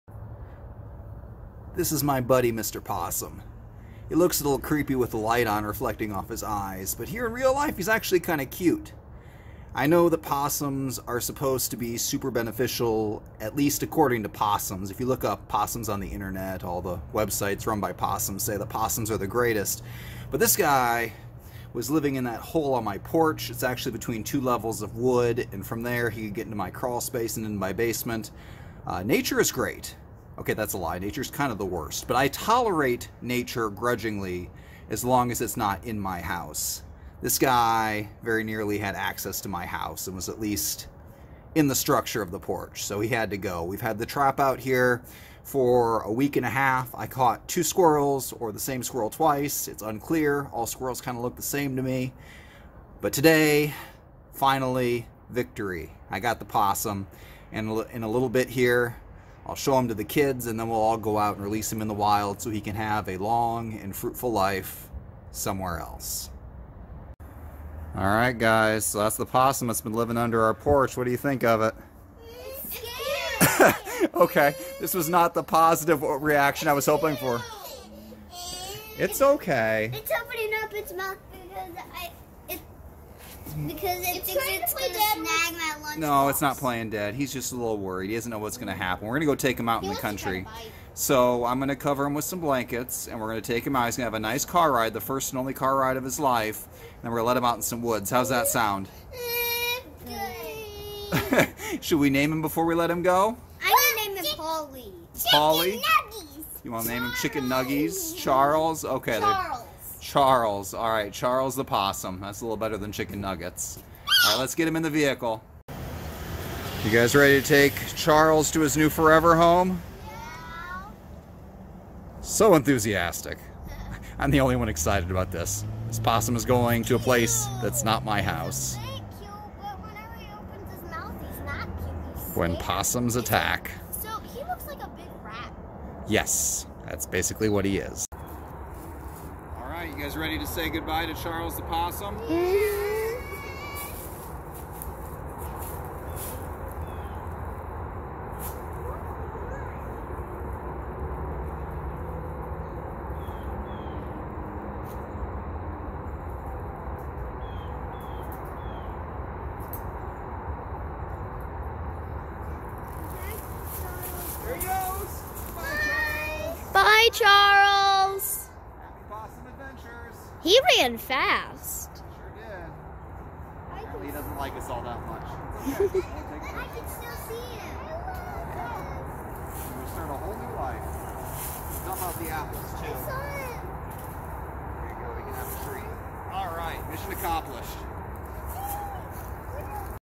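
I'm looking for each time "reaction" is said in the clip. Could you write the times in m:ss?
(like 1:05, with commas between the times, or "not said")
1:16.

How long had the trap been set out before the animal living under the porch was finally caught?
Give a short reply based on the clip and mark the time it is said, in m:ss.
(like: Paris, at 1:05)
a week and a half, at 0:46.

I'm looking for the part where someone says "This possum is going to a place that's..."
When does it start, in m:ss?
2:05.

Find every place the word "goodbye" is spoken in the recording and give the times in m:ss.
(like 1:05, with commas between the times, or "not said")
2:20.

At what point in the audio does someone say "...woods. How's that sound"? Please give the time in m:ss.
1:37.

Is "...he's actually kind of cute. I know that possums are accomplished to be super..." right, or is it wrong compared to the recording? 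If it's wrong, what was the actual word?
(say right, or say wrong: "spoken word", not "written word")
wrong: "supposed", not "accomplished".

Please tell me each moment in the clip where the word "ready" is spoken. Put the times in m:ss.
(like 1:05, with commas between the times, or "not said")
1:57, 2:20.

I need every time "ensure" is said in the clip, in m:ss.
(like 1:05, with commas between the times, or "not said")
not said.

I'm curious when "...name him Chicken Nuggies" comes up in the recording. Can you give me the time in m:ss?
1:46.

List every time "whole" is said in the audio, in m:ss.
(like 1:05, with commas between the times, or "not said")
3:00.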